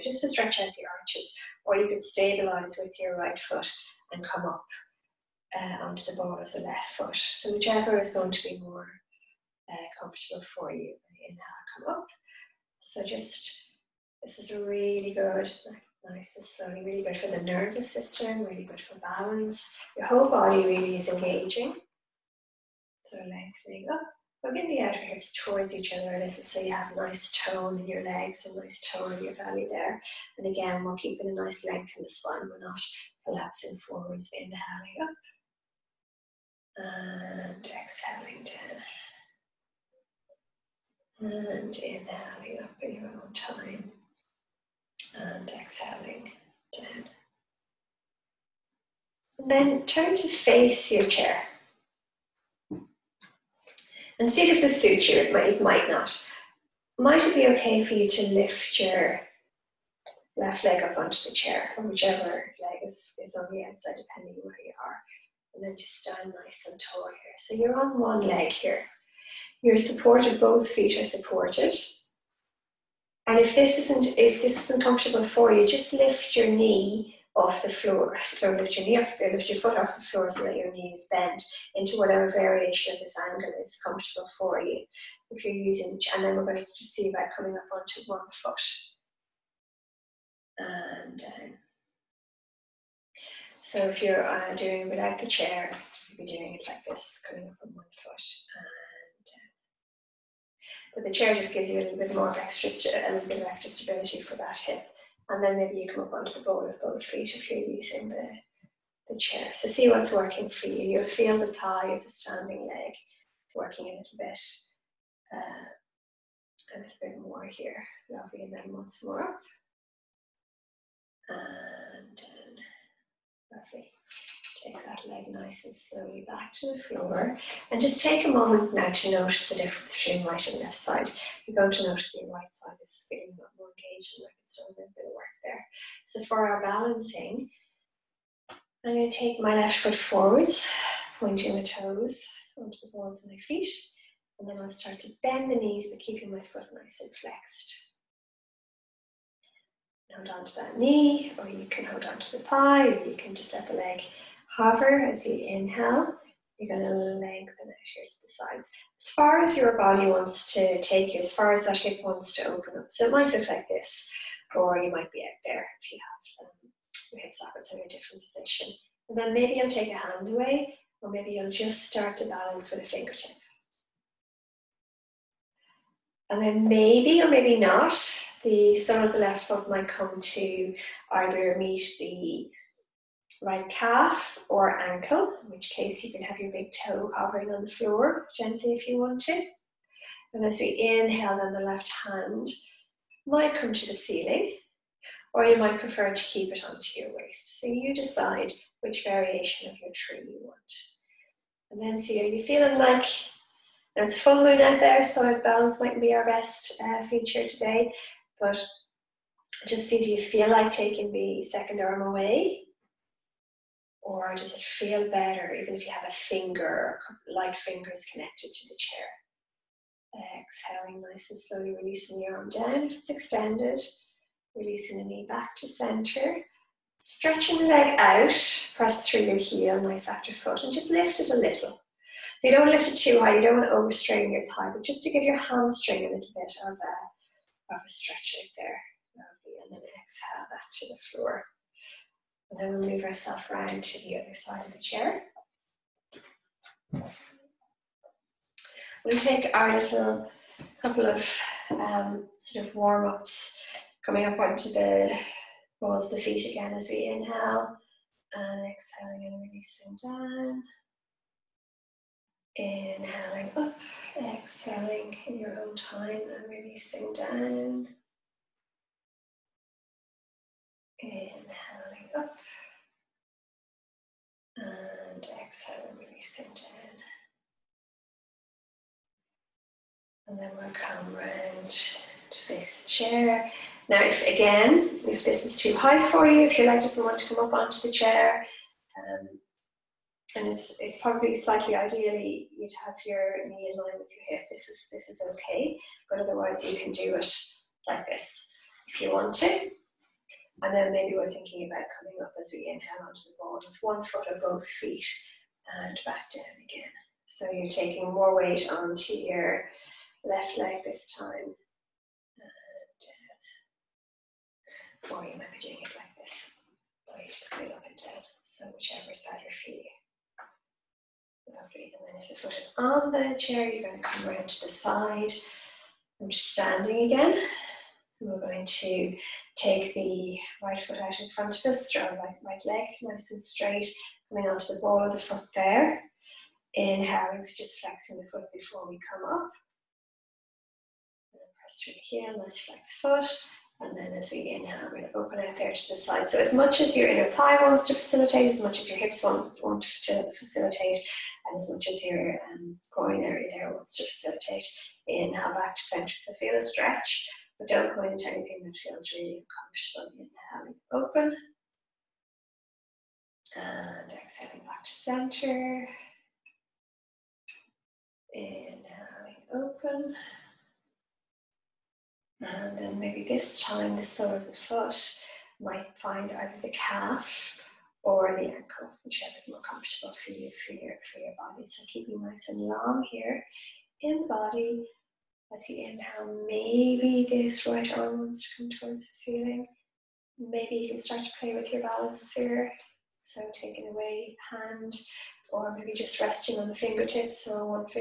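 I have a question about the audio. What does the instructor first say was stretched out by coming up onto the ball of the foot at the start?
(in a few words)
the arches.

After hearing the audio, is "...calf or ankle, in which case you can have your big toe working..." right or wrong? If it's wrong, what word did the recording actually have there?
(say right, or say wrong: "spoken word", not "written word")
wrong: "hovering", not "working".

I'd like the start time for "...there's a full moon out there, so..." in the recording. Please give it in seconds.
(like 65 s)
203 s.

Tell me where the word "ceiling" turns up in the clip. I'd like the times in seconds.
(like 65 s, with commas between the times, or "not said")
193 s, 389 s.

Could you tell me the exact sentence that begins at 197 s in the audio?
So you decide which variation of your tree you want.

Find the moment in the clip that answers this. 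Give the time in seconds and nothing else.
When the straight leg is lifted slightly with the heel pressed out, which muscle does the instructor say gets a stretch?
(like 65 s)
235 s.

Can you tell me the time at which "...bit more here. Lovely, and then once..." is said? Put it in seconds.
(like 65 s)
116 s.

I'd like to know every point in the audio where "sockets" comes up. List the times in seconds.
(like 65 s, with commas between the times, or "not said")
167 s.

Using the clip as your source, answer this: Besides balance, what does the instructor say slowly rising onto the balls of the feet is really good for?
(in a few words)
the nervous system.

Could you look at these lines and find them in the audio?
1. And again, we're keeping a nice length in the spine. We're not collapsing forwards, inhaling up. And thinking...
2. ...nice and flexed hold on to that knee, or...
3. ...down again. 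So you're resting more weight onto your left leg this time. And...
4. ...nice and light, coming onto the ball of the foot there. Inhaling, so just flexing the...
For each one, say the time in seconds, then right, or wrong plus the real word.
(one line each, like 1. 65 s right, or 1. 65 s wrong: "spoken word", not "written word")
1. 30 s wrong: "exhaling", not "thinking"
2. 146 s right
3. 306 s wrong: "taking", not "resting"
4. 333 s wrong: "straight", not "light".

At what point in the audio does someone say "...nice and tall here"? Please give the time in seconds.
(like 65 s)
66 s.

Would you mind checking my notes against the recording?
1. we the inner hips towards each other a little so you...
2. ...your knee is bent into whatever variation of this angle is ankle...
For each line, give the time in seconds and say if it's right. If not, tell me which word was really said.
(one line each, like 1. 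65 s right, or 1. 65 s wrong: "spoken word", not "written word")
1. 24 s wrong: "outer", not "inner"
2. 80 s wrong: "comfortable", not "ankle".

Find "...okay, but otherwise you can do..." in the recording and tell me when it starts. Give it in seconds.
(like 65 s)
295 s.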